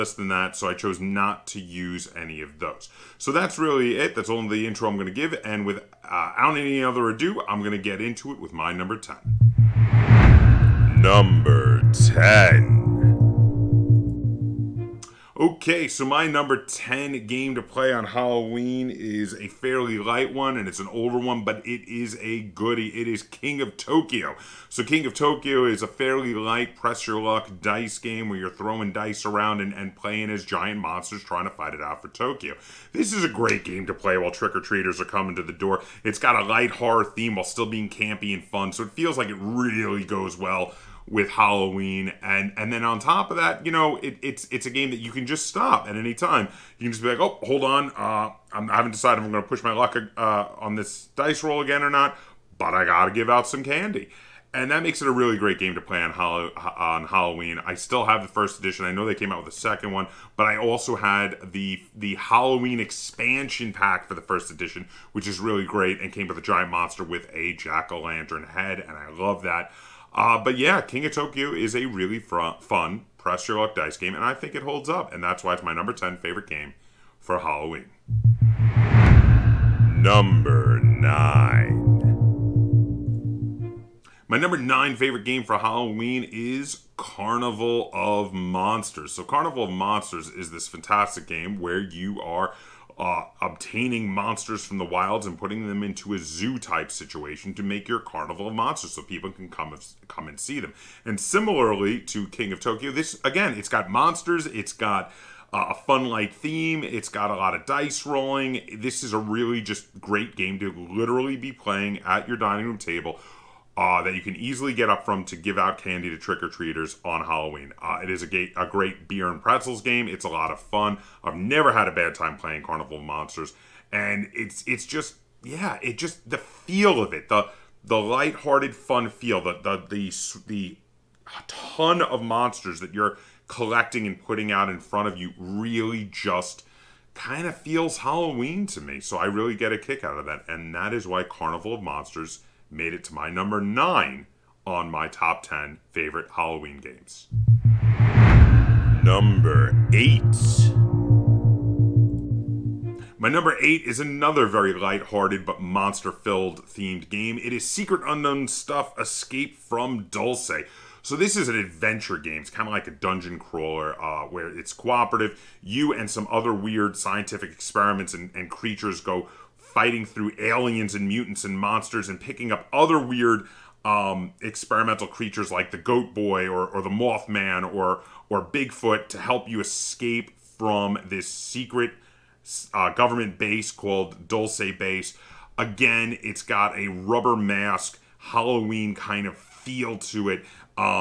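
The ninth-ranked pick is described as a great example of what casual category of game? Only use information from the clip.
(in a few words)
Beer and pretzels game.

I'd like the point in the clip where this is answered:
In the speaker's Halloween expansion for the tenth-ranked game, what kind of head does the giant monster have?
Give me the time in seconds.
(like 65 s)
67 s.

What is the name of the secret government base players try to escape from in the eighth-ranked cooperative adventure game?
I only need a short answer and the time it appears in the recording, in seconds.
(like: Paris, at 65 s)
Dulce Base, at 184 s.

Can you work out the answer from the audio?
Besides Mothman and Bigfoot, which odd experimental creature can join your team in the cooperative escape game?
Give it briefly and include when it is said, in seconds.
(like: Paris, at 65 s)
Goat Boy, at 175 s.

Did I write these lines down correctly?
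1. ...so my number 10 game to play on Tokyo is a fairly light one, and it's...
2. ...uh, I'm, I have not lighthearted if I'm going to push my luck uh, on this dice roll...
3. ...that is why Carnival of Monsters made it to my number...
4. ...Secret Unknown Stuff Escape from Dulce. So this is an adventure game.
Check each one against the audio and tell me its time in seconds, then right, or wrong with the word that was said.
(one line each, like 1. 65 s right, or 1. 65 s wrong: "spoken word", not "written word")
1. 15 s wrong: "Halloween", not "Tokyo"
2. 47 s wrong: "decided", not "lighthearted"
3. 140 s right
4. 157 s right.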